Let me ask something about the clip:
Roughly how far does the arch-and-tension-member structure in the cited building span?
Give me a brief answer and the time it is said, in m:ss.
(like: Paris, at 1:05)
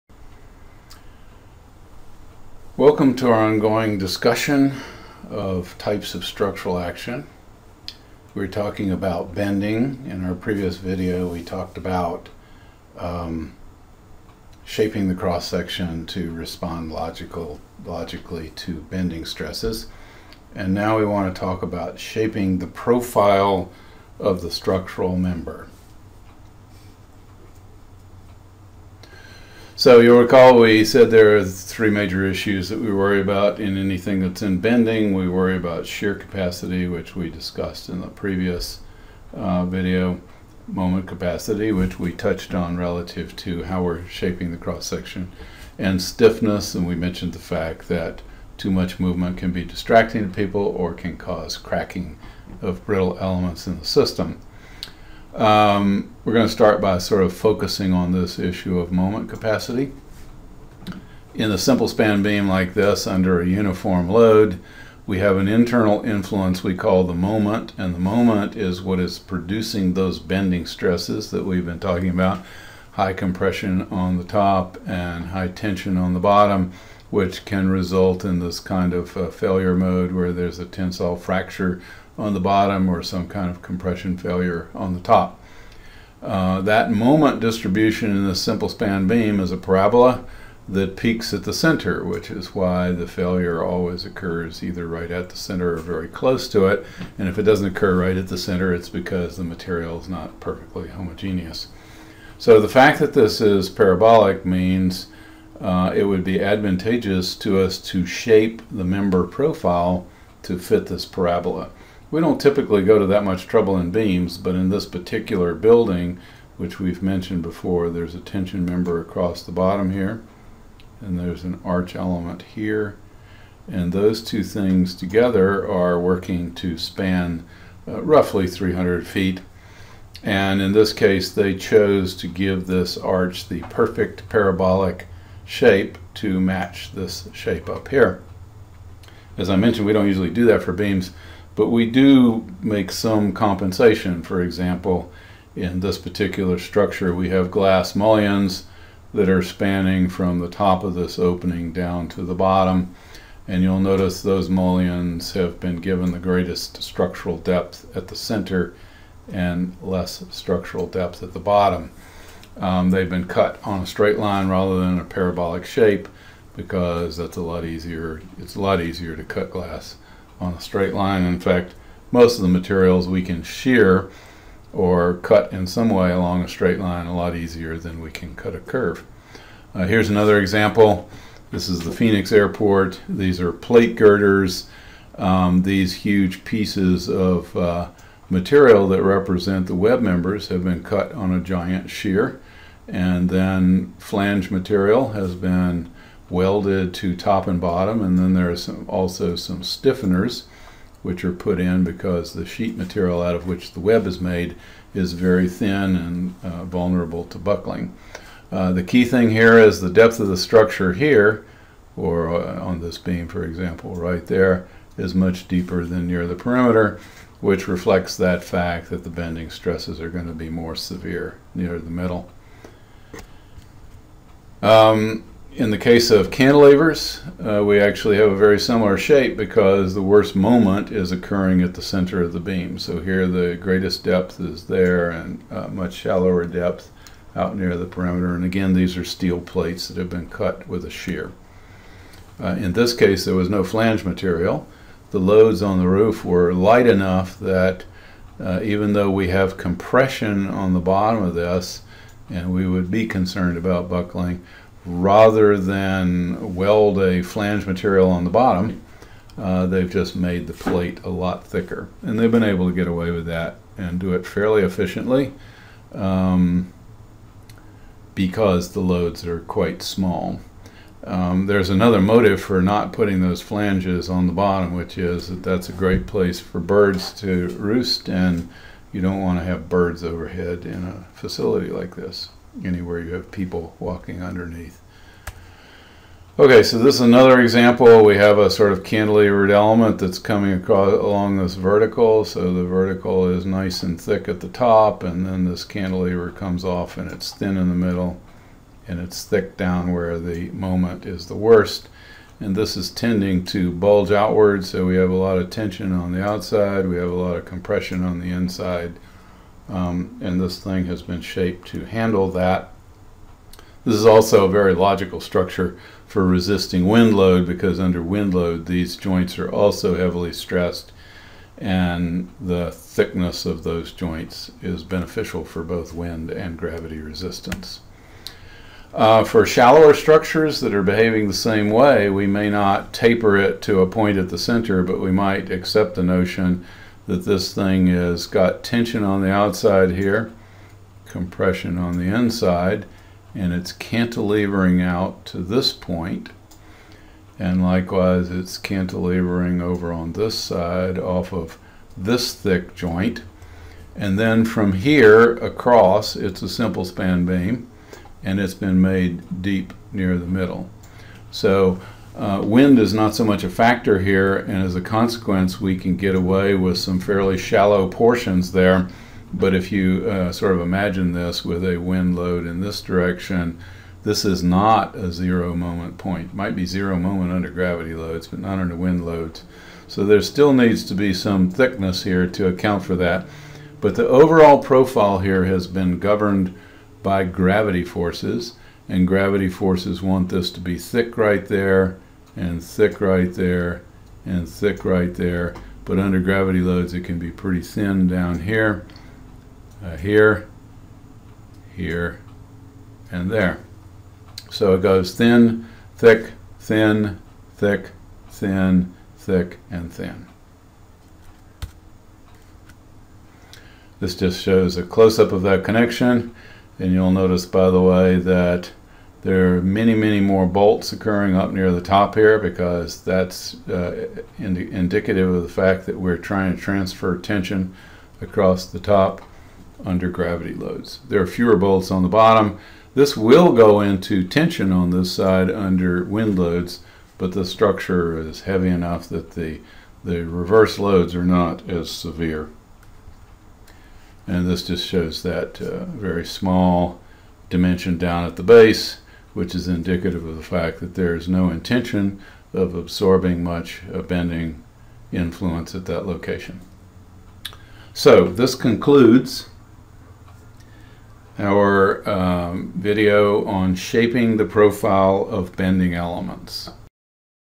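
300 feet, at 2:08.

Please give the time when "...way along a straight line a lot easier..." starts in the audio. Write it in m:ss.
2:55.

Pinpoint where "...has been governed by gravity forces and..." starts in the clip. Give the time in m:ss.
6:25.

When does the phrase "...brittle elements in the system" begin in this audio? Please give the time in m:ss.
0:52.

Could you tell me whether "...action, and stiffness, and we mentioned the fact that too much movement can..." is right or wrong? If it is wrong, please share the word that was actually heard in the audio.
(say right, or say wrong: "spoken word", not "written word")
wrong: "section", not "action".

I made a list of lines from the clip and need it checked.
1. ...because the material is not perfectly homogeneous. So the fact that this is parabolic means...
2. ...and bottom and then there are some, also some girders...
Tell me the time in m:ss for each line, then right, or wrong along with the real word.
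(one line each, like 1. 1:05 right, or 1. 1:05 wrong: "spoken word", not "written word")
1. 1:38 right
2. 3:17 wrong: "stiffeners", not "girders".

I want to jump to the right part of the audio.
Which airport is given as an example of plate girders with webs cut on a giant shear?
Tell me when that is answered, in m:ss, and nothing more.
3:01.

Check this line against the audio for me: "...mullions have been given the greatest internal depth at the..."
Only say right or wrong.
wrong.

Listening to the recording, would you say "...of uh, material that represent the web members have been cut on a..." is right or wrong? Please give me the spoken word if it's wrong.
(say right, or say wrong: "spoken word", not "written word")
right.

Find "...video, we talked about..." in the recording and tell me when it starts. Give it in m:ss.
0:10.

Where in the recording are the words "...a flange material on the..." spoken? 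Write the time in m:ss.
4:16.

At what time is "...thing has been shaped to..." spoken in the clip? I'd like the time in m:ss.
5:10.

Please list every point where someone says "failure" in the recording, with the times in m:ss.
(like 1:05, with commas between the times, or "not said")
1:19, 1:24, 1:33.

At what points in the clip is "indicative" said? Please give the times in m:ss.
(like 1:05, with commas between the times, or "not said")
7:04, 7:29.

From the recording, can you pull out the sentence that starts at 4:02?
Uh, in this case, there was no flange material.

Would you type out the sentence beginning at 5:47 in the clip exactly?
And likewise, it's cantilevering over on this side off of this thick joint.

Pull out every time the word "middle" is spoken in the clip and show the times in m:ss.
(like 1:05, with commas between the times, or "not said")
3:41, 4:57, 6:00.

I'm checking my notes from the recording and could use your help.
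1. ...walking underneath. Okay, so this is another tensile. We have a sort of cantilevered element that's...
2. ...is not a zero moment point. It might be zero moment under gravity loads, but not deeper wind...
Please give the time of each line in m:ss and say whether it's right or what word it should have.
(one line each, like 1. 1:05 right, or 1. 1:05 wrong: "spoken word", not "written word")
1. 4:43 wrong: "example", not "tensile"
2. 6:14 wrong: "under", not "deeper".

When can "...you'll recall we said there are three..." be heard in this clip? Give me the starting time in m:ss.
0:29.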